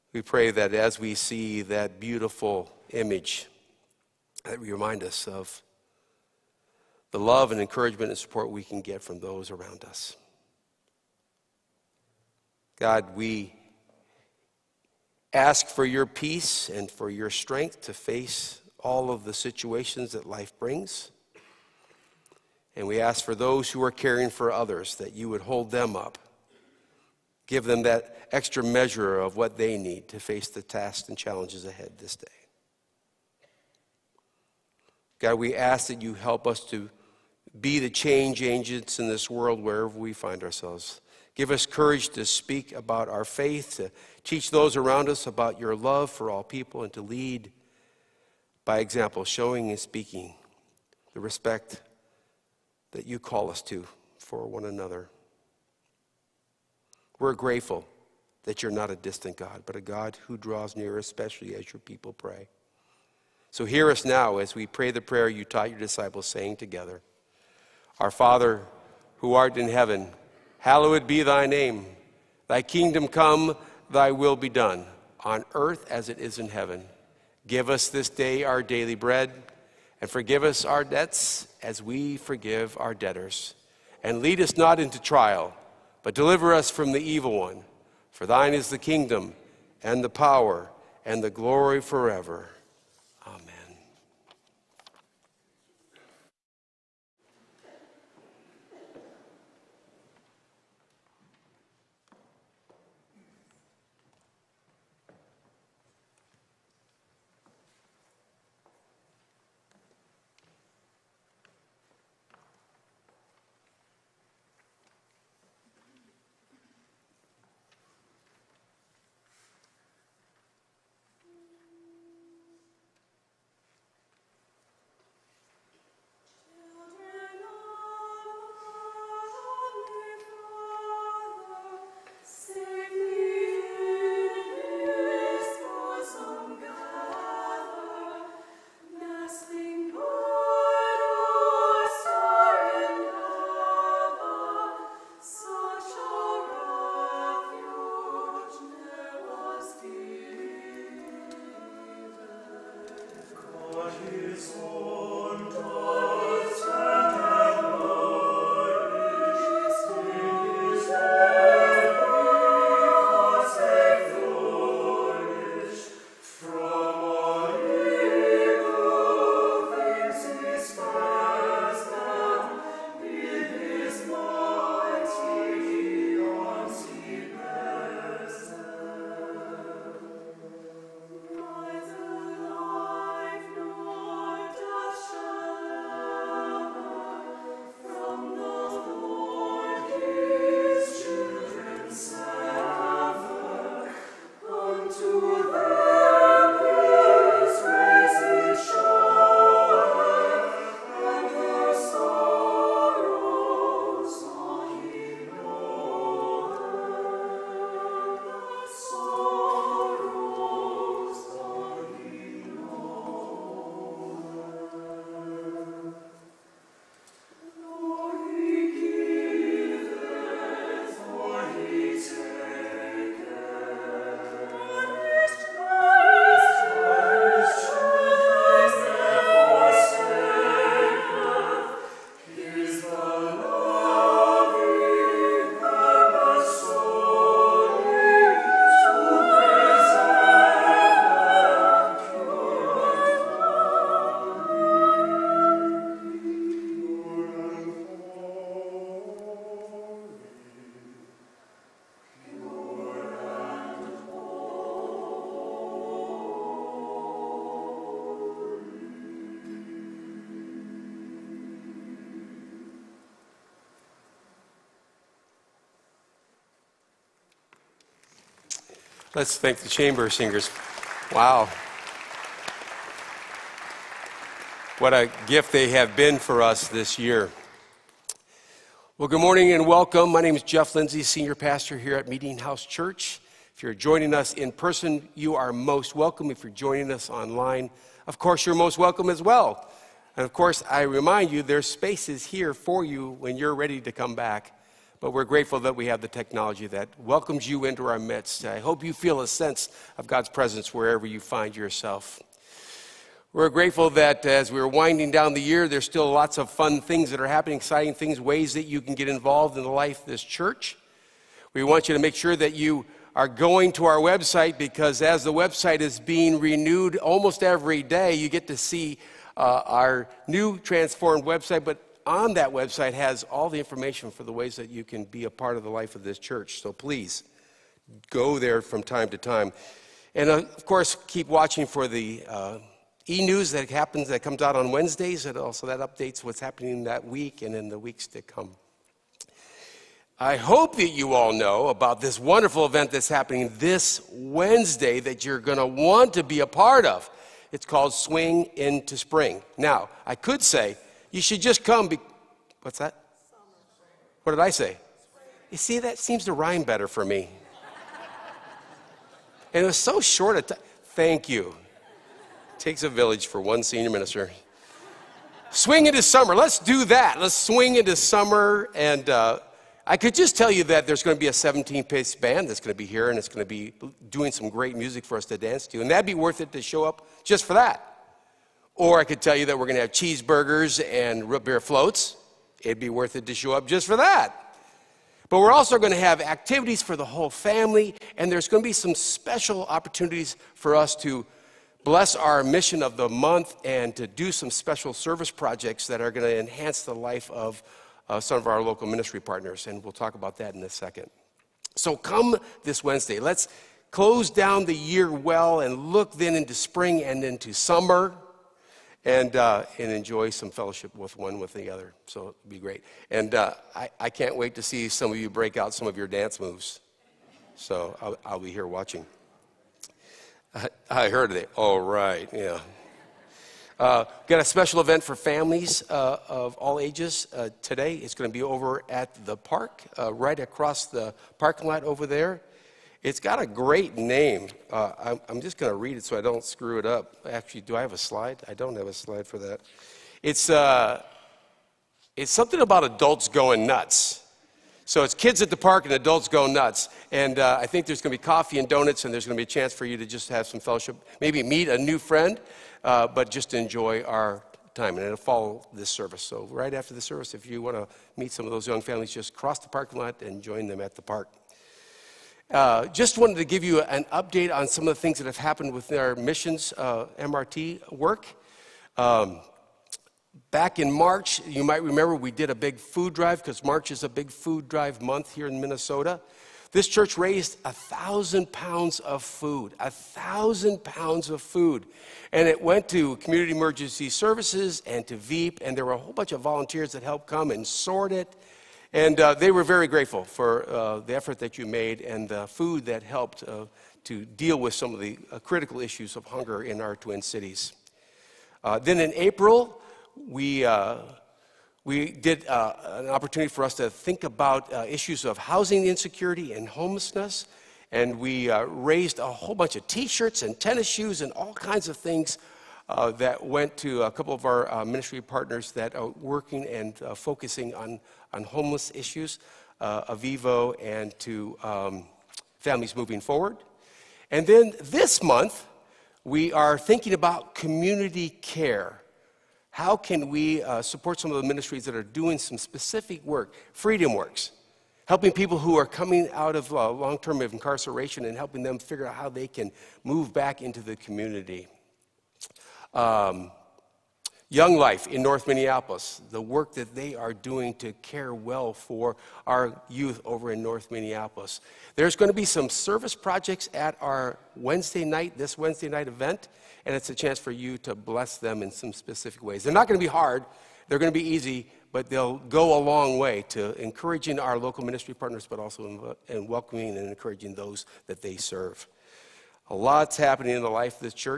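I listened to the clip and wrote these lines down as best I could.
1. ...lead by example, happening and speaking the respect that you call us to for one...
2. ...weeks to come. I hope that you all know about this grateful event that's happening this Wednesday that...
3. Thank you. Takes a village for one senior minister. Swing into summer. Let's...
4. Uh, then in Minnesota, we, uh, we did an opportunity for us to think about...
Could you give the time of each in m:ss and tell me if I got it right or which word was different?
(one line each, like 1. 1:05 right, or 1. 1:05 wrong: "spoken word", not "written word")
1. 0:47 wrong: "showing", not "happening"
2. 5:37 wrong: "wonderful", not "grateful"
3. 6:00 right
4. 8:18 wrong: "April", not "Minnesota".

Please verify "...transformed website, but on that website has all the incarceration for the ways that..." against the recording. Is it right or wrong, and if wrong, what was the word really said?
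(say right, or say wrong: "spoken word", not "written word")
wrong: "information", not "incarceration".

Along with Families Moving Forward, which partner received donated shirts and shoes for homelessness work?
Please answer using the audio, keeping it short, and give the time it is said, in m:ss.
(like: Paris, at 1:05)
Avivo, at 8:40.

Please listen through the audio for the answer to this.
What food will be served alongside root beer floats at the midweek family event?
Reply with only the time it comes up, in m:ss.
6:19.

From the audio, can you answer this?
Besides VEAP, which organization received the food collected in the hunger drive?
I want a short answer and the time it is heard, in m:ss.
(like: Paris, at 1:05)
Community Emergency Services, at 8:03.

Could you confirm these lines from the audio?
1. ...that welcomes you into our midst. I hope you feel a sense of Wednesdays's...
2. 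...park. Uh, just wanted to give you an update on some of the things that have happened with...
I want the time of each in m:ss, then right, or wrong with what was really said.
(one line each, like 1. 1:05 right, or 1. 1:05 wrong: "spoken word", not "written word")
1. 4:56 wrong: "God", not "Wednesdays"
2. 7:41 right.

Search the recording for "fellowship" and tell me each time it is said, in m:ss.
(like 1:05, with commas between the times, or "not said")
6:50, 7:30.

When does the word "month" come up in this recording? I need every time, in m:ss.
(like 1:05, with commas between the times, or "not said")
6:33, 7:54, 8:45.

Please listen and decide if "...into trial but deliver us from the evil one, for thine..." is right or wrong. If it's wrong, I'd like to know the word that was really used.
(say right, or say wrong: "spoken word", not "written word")
right.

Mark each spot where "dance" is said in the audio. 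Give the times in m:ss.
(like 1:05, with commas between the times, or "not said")
6:15, 6:56.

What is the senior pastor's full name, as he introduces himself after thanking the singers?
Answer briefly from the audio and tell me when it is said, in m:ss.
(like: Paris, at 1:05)
Jeff Lindsay, at 4:40.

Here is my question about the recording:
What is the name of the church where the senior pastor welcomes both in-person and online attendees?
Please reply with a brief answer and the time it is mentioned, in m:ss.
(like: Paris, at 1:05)
Meetinghouse Church, at 4:42.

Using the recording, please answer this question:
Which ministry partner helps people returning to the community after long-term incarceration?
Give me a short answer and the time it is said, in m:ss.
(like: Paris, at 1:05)
Freedom Works, at 8:53.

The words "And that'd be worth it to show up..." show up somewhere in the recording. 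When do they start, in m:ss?
6:15.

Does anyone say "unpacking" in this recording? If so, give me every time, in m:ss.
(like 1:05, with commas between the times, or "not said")
not said.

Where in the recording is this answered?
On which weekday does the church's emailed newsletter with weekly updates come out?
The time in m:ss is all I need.
5:34.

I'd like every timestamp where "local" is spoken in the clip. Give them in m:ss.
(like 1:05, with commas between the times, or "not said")
6:38, 9:24.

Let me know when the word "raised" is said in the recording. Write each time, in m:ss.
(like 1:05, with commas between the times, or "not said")
7:57, 8:28.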